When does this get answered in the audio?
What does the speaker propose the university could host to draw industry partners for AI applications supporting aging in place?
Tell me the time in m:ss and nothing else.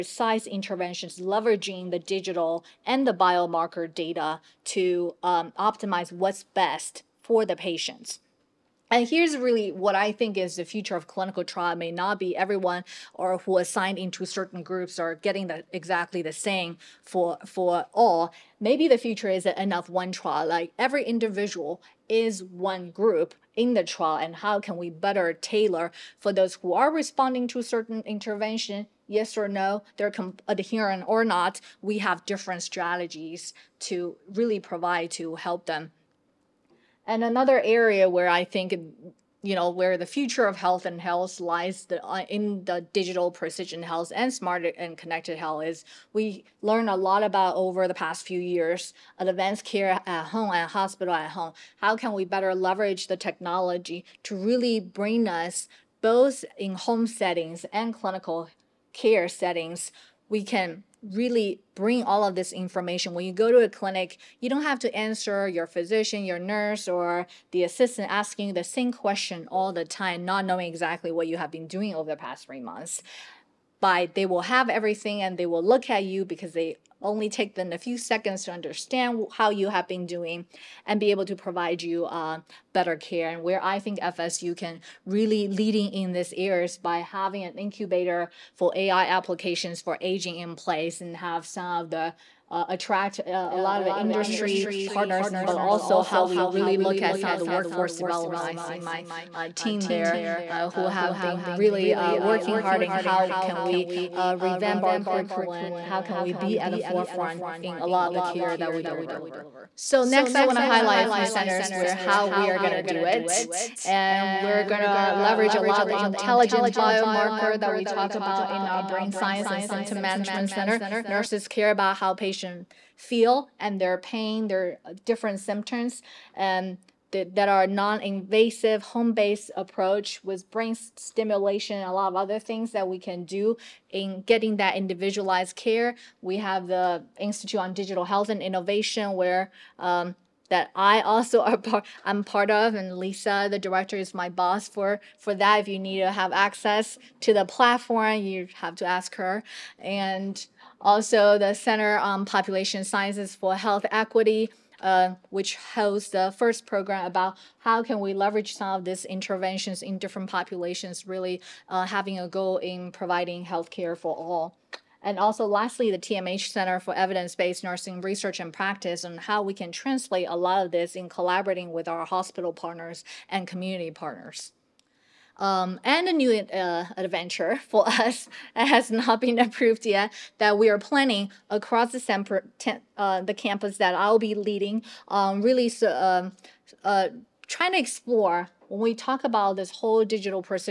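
1:27.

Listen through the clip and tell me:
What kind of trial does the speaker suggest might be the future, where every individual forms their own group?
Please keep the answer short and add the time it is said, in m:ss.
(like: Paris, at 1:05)
N-of-one trial, at 0:19.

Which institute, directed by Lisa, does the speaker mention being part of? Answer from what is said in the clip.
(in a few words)
Institute on Digital Health and Innovation.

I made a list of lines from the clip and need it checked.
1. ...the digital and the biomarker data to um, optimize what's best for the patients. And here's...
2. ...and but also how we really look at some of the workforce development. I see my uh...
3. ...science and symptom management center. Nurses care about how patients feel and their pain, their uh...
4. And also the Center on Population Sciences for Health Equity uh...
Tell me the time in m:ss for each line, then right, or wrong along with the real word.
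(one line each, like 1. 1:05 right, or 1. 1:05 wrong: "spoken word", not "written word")
1. 0:01 right
2. 1:35 right
3. 1:59 right
4. 2:29 right.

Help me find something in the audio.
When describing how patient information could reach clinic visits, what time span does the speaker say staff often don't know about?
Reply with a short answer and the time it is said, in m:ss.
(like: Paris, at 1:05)
past three months, at 1:12.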